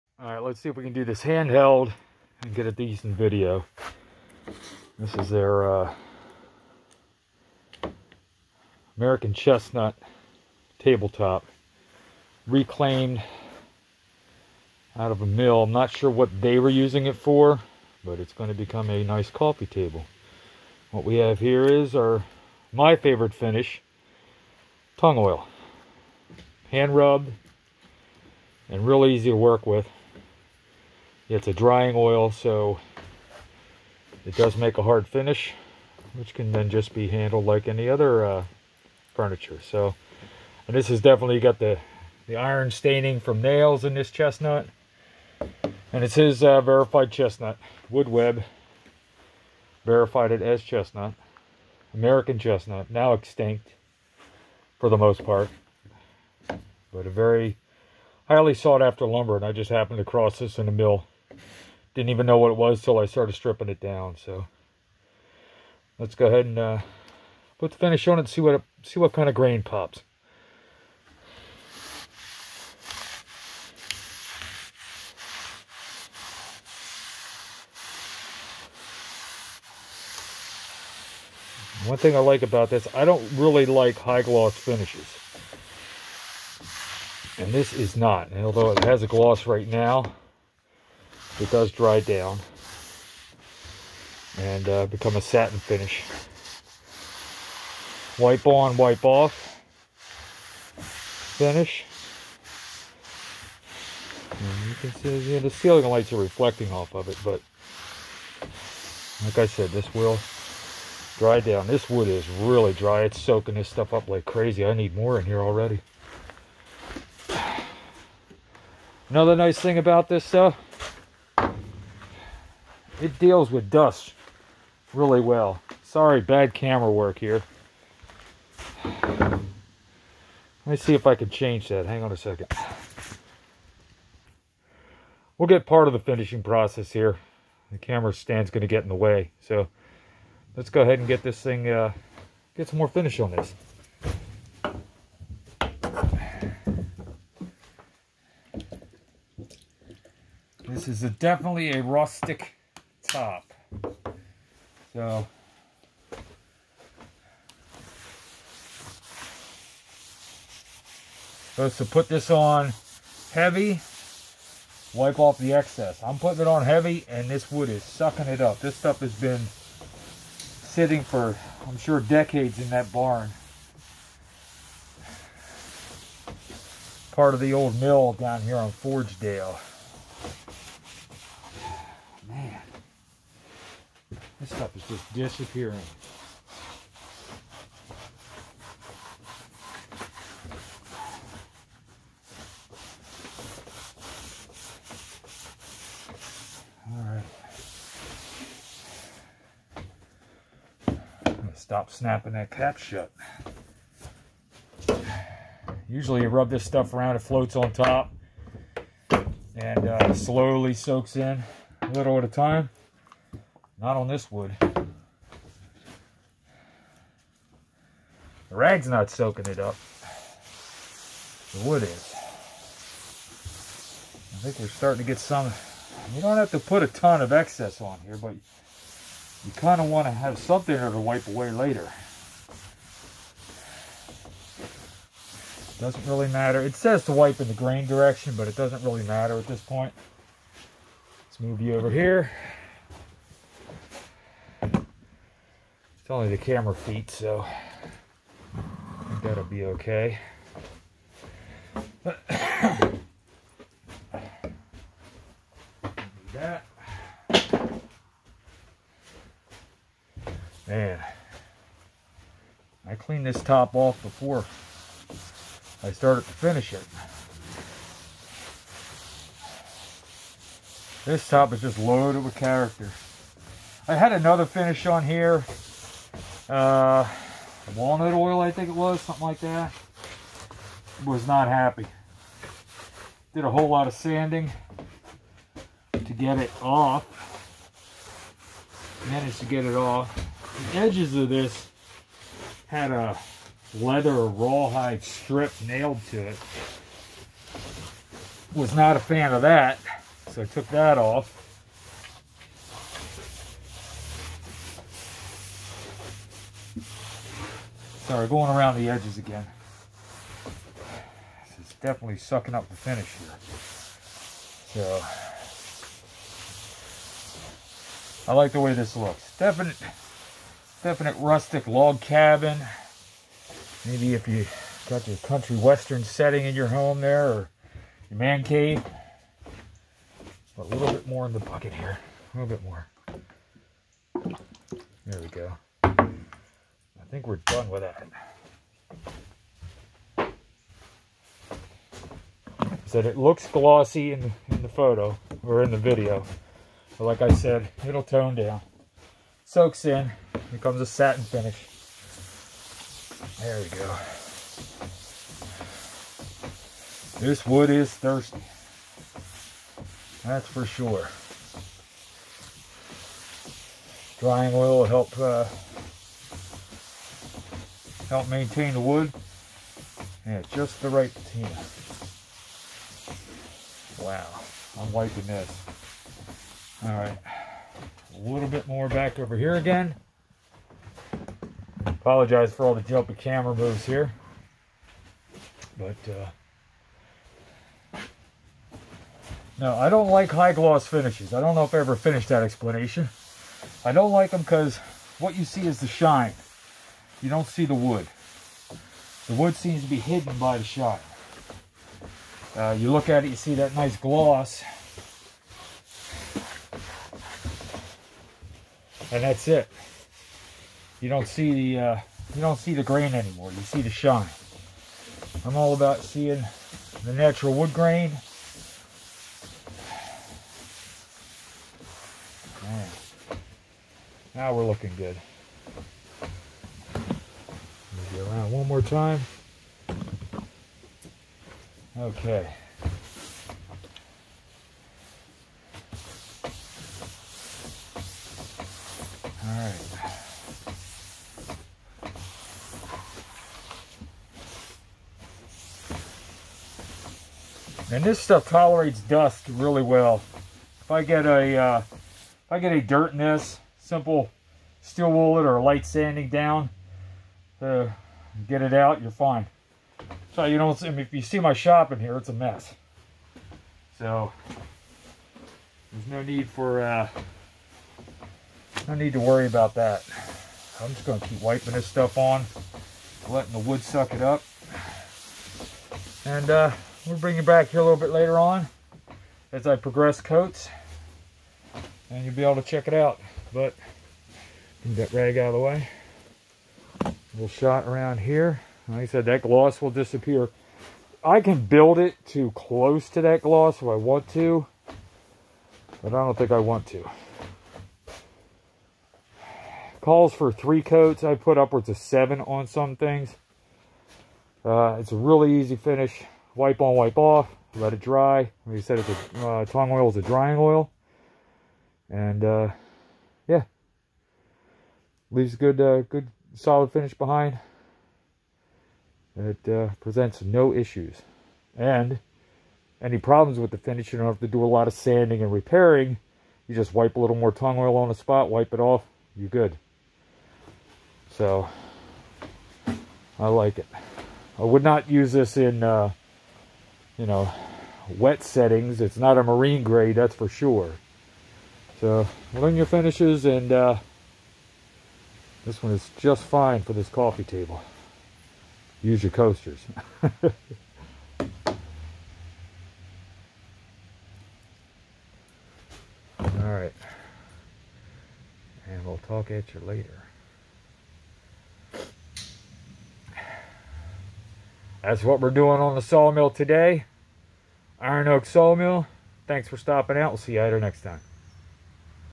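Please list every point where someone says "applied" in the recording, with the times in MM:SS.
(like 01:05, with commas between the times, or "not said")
not said.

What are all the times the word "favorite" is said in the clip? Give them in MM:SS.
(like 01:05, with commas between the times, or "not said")
00:22.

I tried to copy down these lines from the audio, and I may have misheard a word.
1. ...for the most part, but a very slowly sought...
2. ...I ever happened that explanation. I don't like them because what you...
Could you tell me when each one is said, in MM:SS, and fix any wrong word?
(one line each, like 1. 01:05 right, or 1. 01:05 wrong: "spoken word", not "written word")
1. 00:54 wrong: "highly", not "slowly"
2. 06:31 wrong: "finished", not "happened".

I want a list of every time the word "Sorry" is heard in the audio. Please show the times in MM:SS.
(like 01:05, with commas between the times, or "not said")
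02:05, 05:08.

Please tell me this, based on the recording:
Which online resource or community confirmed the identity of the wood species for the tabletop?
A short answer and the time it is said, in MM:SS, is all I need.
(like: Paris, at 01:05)
Wood Web, at 00:47.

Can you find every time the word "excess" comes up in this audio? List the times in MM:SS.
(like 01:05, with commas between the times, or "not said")
02:45, 03:47.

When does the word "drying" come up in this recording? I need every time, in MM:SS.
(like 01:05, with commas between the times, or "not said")
00:31, 06:04, 08:30.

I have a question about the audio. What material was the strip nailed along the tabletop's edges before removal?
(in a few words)
leather or rawhide.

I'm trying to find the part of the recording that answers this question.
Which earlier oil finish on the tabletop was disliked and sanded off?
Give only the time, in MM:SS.
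04:37.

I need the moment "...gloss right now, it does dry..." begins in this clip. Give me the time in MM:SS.
01:29.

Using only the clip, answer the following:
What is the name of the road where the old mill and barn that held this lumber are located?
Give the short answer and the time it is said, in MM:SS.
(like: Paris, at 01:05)
Forgedale, at 02:58.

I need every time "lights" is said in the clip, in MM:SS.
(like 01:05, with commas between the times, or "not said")
01:45, 07:35.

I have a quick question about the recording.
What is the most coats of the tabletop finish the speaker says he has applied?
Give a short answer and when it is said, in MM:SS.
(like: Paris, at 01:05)
7, at 08:21.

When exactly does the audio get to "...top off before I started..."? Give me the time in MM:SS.
04:23.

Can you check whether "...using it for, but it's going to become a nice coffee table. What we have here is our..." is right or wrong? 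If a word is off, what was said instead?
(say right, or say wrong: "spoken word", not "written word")
right.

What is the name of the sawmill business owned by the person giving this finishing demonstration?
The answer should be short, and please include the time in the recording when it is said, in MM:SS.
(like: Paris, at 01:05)
Iron Oak Sawmill, at 09:27.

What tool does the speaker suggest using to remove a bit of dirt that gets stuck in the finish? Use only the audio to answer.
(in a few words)
steel wool.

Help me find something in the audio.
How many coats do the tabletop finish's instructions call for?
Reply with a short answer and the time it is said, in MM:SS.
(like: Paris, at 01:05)
3, at 08:20.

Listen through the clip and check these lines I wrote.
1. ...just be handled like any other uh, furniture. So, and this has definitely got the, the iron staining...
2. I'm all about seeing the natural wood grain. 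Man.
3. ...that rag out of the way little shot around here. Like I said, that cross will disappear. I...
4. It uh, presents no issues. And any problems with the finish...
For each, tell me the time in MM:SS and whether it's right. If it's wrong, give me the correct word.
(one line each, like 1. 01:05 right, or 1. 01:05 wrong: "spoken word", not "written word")
1. 00:36 right
2. 06:55 right
3. 08:05 wrong: "gloss", not "cross"
4. 08:39 right.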